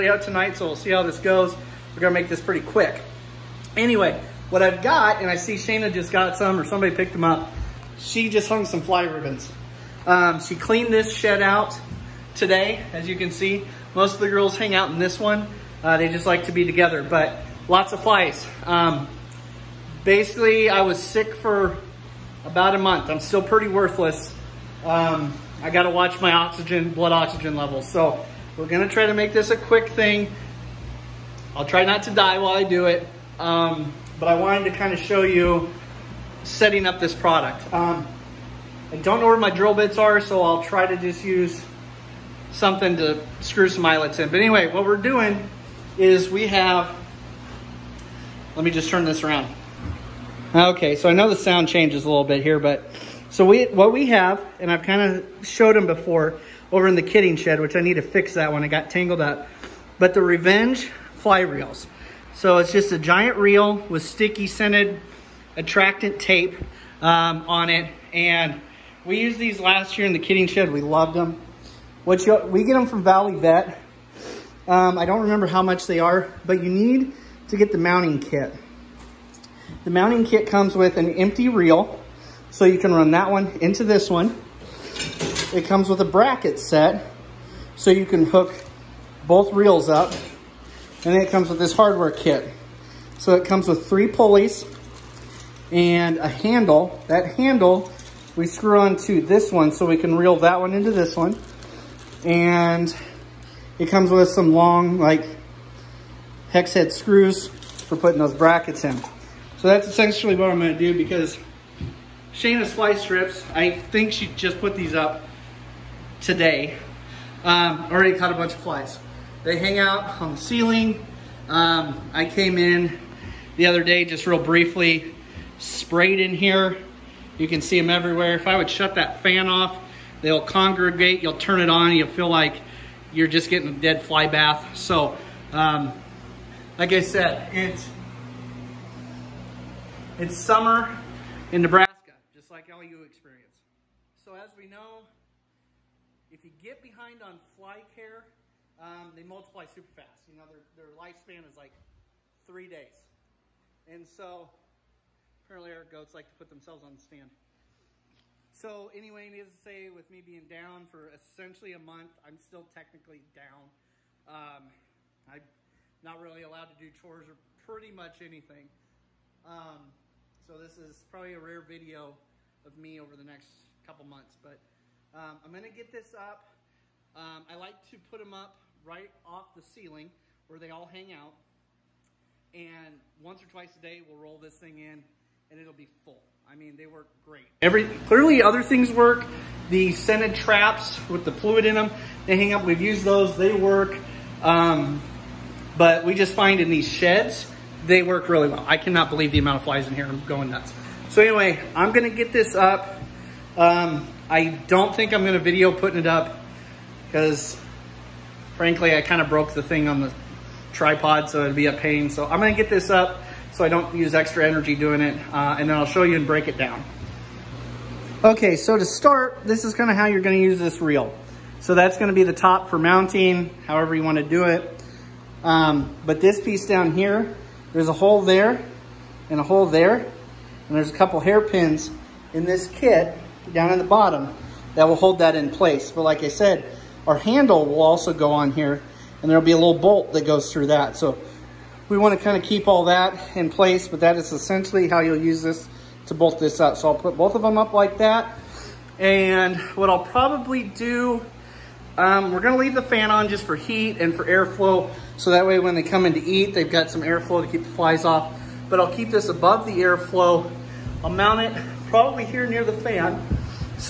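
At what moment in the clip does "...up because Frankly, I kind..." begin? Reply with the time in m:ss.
3:26.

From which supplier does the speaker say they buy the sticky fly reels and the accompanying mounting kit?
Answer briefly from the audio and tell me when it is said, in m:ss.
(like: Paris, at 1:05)
Valley Vet, at 1:13.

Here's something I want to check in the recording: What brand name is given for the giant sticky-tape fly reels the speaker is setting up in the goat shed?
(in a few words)
Revenge.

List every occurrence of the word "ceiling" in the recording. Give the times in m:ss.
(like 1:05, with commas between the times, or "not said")
2:00, 2:59.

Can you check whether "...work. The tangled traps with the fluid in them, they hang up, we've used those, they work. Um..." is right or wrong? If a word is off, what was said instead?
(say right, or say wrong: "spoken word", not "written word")
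wrong: "scented", not "tangled".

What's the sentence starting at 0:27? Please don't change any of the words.
So we're gonna try to make this a quick thing.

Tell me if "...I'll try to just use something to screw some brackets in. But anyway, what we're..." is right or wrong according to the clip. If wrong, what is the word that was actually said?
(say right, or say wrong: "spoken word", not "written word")
wrong: "eyelets", not "brackets".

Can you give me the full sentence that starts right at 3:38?
Okay, so to start, this is kind of how you're gonna use this reel.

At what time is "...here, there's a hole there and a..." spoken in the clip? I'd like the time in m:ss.
3:46.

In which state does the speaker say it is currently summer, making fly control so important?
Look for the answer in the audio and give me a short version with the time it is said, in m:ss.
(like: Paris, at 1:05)
Nebraska, at 2:21.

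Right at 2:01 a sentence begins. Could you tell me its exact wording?
Um, I came in the other day, just real briefly, sprayed in here.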